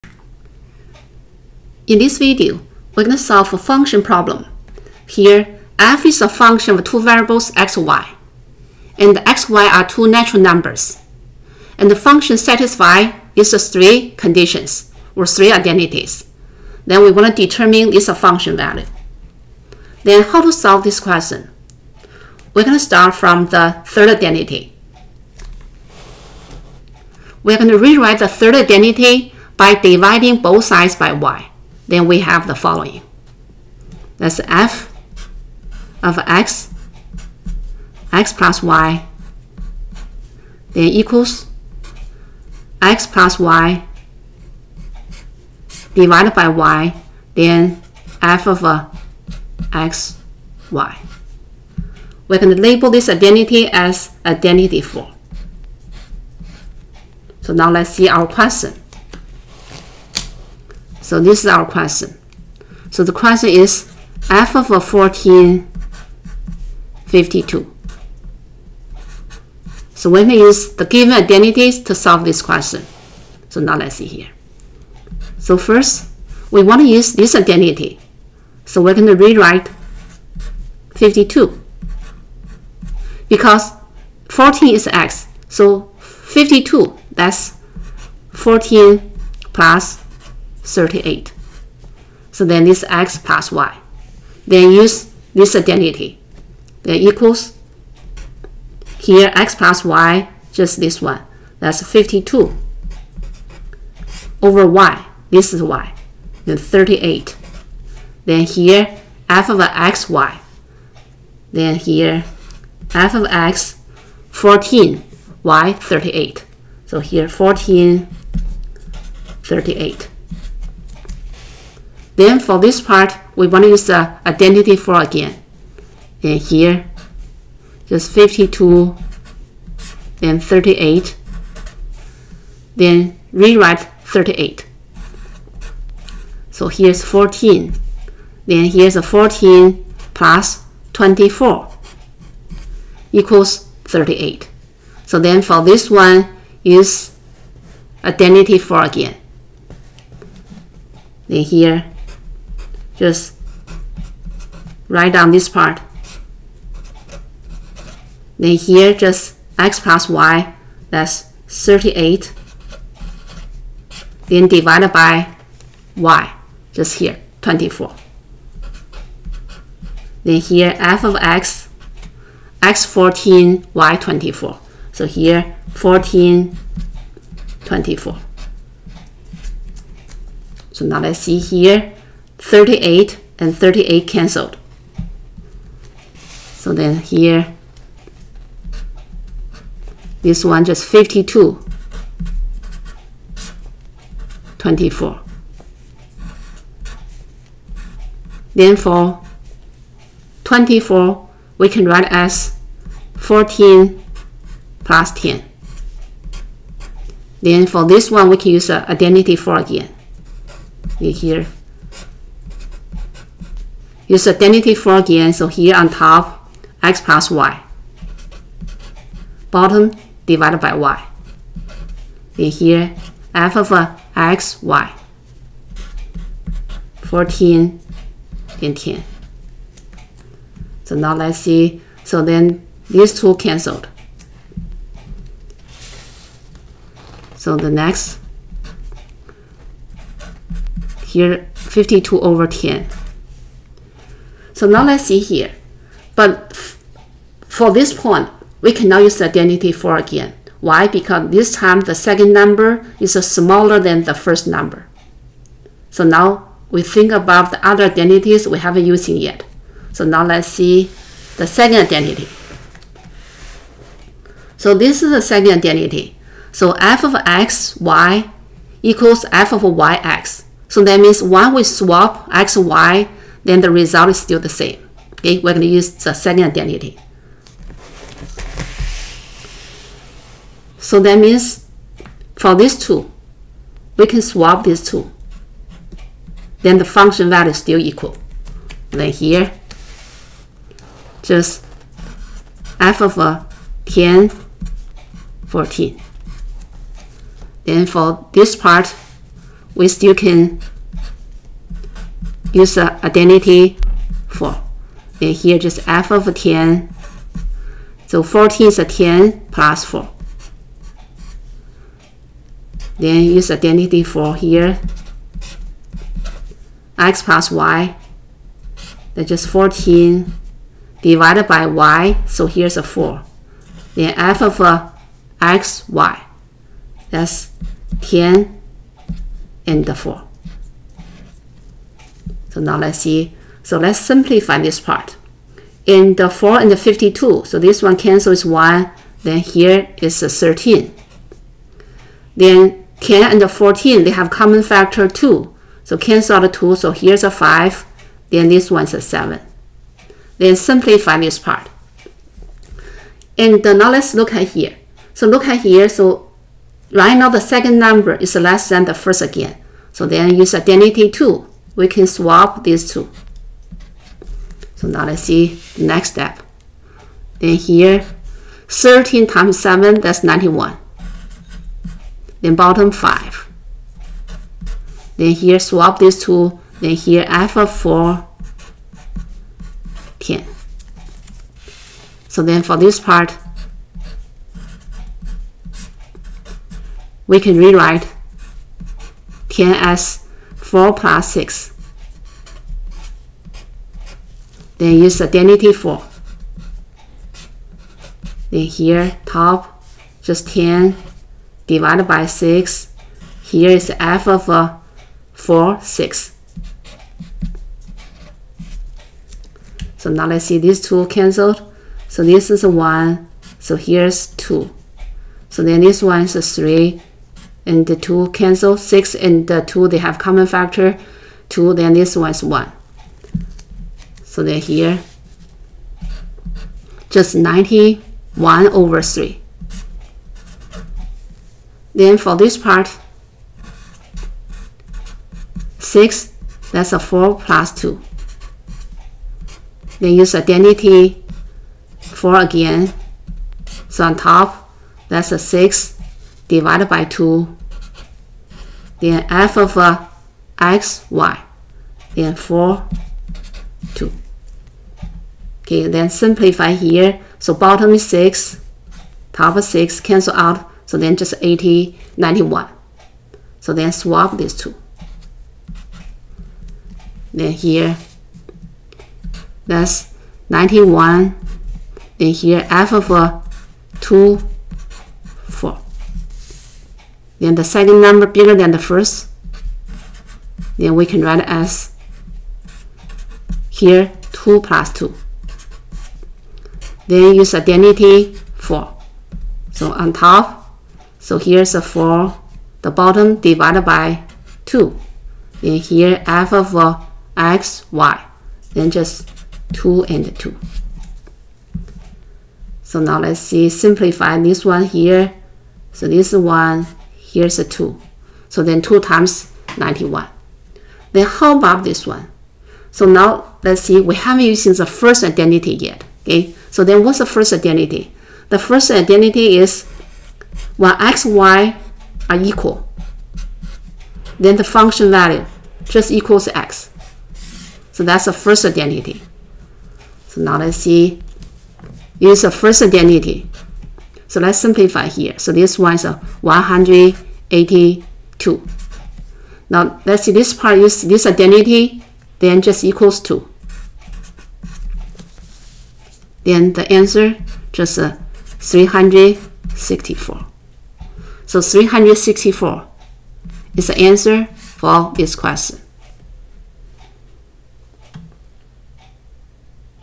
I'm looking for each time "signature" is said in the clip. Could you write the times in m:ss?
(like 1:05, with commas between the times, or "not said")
not said.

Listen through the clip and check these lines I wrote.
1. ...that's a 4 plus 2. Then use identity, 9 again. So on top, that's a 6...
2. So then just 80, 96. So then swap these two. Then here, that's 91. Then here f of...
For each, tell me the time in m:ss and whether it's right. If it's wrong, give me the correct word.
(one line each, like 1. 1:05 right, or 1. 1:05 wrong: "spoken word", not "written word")
1. 7:16 wrong: "4", not "9"
2. 7:40 wrong: "91", not "96".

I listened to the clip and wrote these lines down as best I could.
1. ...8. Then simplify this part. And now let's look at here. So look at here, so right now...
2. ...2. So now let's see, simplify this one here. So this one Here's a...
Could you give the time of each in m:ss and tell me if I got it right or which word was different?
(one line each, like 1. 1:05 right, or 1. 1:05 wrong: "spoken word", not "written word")
1. 5:49 wrong: "7", not "8"
2. 8:20 right.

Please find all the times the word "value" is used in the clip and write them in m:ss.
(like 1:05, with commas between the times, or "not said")
0:18, 4:47, 8:45.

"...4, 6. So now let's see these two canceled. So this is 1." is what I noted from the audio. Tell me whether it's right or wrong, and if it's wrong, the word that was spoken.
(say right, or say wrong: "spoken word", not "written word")
right.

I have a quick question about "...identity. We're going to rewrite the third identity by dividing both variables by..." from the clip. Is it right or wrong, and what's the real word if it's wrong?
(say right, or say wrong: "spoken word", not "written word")
wrong: "sides", not "variables".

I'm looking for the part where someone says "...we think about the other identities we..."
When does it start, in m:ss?
4:16.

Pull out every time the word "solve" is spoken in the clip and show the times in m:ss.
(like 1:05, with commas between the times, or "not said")
0:03, 0:20, 1:11.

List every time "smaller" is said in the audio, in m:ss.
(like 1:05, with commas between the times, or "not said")
4:13.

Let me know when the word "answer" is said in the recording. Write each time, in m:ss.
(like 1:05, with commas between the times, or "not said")
9:06, 9:13.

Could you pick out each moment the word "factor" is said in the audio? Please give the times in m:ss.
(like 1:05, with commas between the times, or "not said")
5:44, 7:00.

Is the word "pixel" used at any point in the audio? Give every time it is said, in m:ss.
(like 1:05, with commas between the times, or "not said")
not said.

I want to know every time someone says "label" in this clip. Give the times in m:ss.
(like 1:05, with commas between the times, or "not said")
0:52.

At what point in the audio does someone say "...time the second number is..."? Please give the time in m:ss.
4:11.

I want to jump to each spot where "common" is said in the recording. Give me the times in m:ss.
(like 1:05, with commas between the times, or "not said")
5:44, 7:00.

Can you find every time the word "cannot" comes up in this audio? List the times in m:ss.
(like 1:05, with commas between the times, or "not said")
4:08.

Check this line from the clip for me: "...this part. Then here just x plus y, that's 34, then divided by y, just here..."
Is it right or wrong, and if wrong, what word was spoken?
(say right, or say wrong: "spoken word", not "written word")
wrong: "38", not "34".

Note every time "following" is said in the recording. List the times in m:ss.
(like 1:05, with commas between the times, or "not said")
0:32.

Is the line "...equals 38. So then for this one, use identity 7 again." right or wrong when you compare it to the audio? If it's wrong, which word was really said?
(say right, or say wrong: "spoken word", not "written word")
wrong: "4", not "7".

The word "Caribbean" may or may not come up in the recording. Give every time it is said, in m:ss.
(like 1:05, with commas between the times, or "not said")
not said.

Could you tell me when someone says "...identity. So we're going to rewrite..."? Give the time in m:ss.
1:17.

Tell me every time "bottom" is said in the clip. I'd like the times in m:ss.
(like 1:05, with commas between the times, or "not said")
3:39, 6:12, 7:37, 8:12.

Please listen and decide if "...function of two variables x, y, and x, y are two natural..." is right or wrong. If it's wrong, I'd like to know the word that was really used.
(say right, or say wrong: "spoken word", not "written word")
right.